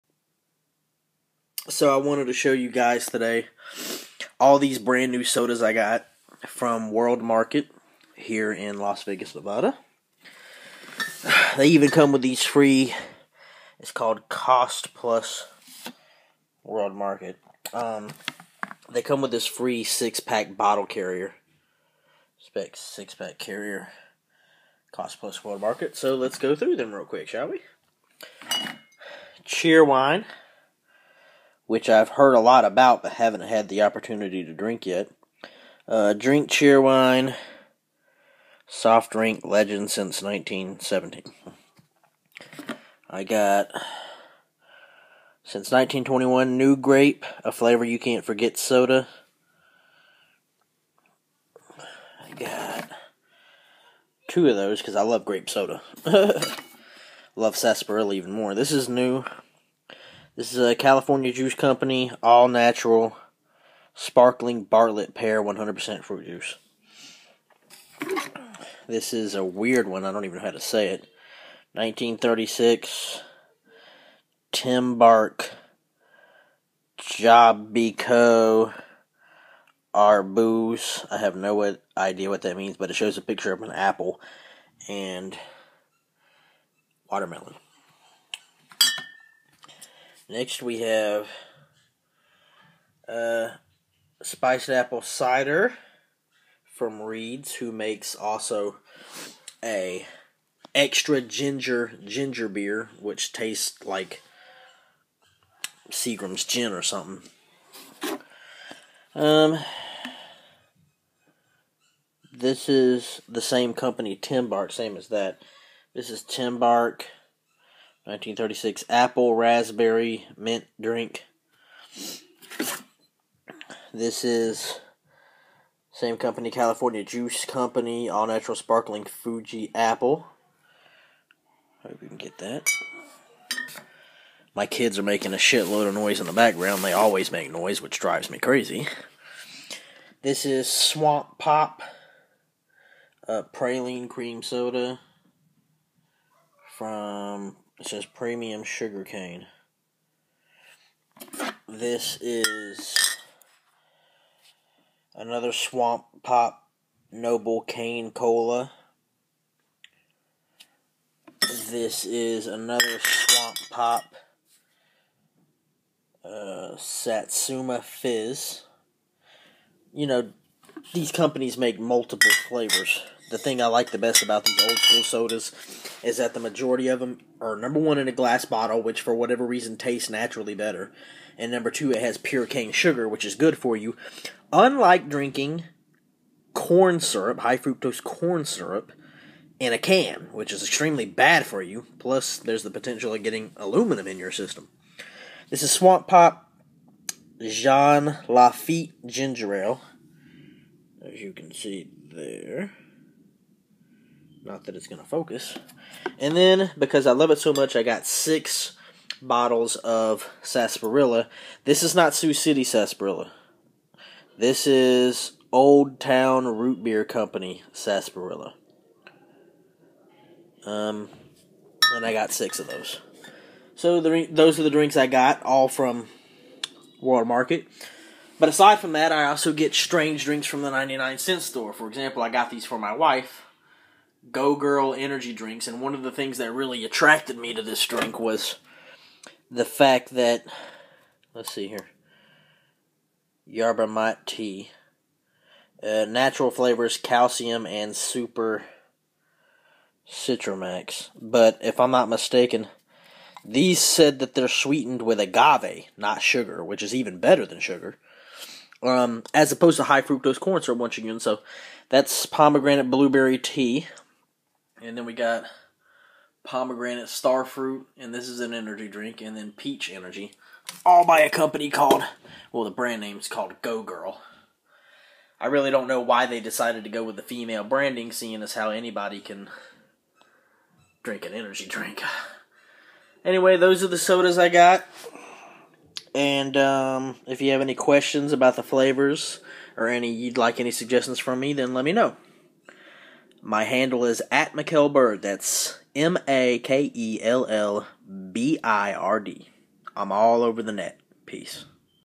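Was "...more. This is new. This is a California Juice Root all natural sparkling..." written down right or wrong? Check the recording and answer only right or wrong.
wrong.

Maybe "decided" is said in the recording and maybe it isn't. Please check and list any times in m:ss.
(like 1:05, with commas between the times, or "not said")
4:36.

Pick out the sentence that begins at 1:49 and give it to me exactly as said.
Um, this is the same company, Tymbark, same as that.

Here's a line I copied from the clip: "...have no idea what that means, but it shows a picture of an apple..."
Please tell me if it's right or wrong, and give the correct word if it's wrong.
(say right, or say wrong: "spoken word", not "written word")
right.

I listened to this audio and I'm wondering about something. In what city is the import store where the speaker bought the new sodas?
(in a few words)
Las Vegas.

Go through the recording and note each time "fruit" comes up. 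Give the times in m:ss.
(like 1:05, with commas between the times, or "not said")
1:06, 4:27.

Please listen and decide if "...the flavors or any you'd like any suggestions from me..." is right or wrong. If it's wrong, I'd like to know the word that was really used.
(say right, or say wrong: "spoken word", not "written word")
right.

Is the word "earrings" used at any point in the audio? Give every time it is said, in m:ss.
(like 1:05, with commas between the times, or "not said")
not said.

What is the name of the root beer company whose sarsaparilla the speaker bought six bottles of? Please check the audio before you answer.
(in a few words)
Old Town Root Beer Company.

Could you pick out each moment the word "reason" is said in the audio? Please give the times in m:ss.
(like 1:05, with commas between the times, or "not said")
2:59.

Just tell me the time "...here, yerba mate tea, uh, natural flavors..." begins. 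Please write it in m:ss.
4:01.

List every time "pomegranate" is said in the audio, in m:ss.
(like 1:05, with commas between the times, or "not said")
4:22, 4:26.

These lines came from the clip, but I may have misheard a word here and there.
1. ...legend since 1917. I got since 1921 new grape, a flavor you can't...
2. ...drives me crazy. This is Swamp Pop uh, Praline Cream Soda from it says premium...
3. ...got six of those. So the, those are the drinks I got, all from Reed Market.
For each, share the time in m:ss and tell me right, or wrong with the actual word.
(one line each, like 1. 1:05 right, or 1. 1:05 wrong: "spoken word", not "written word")
1. 0:39 right
2. 2:17 right
3. 3:42 wrong: "World", not "Reed".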